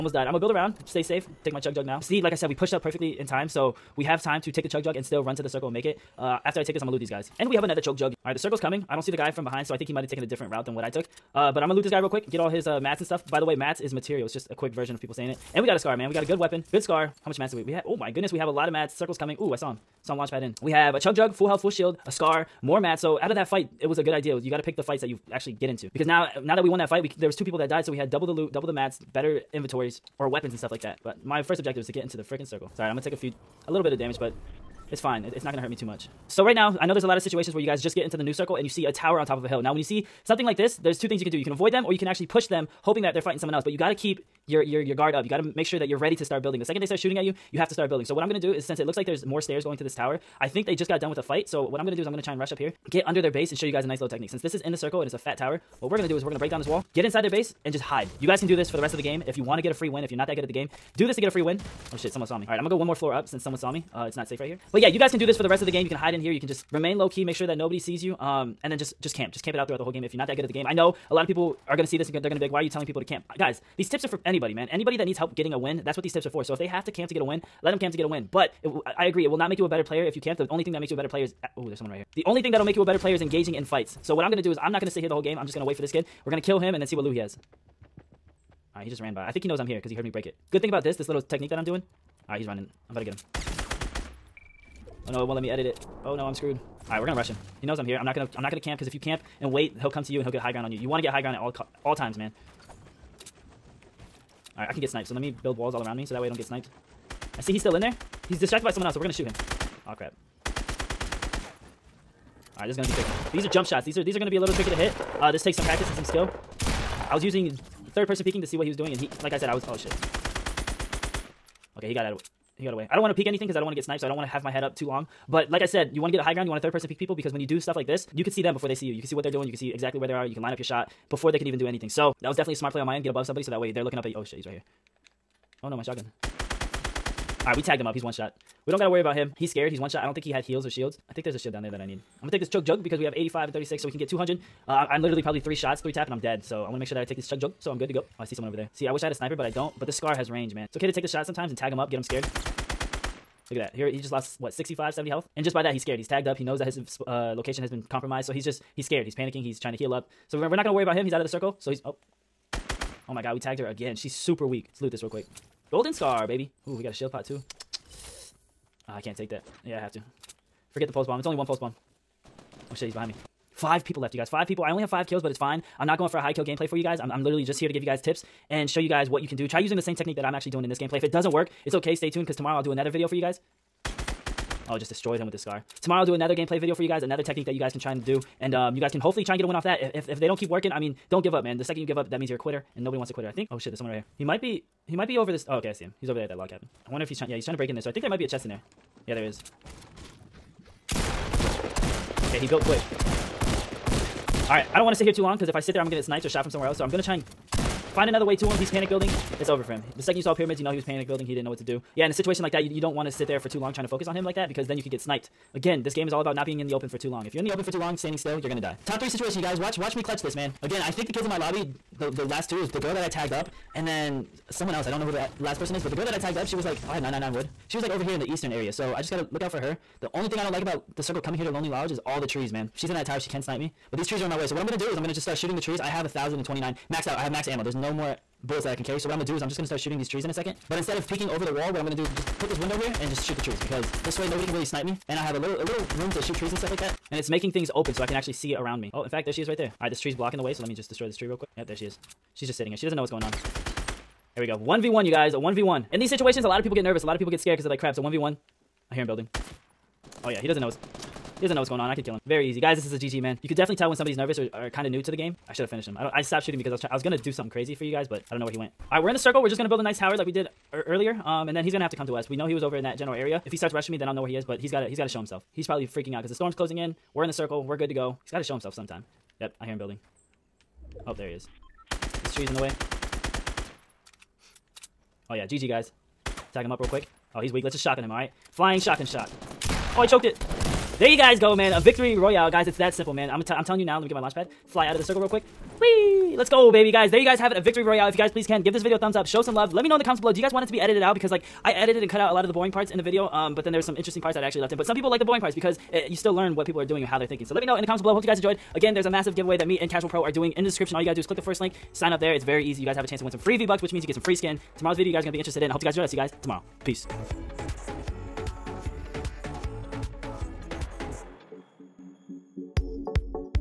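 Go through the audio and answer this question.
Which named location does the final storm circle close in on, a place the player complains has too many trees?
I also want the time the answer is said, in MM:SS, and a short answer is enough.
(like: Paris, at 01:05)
Lonely Lodge, at 03:51.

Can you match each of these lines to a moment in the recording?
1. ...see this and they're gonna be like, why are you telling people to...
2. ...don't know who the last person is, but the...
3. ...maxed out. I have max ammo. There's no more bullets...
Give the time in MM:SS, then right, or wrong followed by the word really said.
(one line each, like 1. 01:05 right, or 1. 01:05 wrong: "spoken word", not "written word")
1. 01:11 right
2. 03:44 right
3. 03:56 right.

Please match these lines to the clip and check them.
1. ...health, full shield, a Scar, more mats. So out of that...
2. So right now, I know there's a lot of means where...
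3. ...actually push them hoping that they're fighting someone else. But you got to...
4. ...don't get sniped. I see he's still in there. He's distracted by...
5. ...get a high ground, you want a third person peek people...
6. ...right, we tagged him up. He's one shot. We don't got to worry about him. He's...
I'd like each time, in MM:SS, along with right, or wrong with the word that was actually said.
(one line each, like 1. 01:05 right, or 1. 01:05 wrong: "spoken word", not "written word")
1. 00:21 right
2. 00:36 wrong: "situations", not "means"
3. 00:42 right
4. 01:46 right
5. 02:06 right
6. 02:17 right.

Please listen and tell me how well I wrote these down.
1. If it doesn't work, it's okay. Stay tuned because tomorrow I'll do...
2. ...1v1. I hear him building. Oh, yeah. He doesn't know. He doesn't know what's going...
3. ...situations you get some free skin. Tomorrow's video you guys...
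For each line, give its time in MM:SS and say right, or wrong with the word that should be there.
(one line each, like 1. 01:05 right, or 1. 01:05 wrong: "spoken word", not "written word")
1. 03:00 right
2. 04:18 right
3. 05:13 wrong: "means", not "situations".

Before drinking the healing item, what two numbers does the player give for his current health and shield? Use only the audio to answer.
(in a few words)
85 and 36.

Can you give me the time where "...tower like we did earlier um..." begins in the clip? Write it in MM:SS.
04:29.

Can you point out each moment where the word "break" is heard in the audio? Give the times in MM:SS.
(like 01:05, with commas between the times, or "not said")
00:56, 01:30, 03:17.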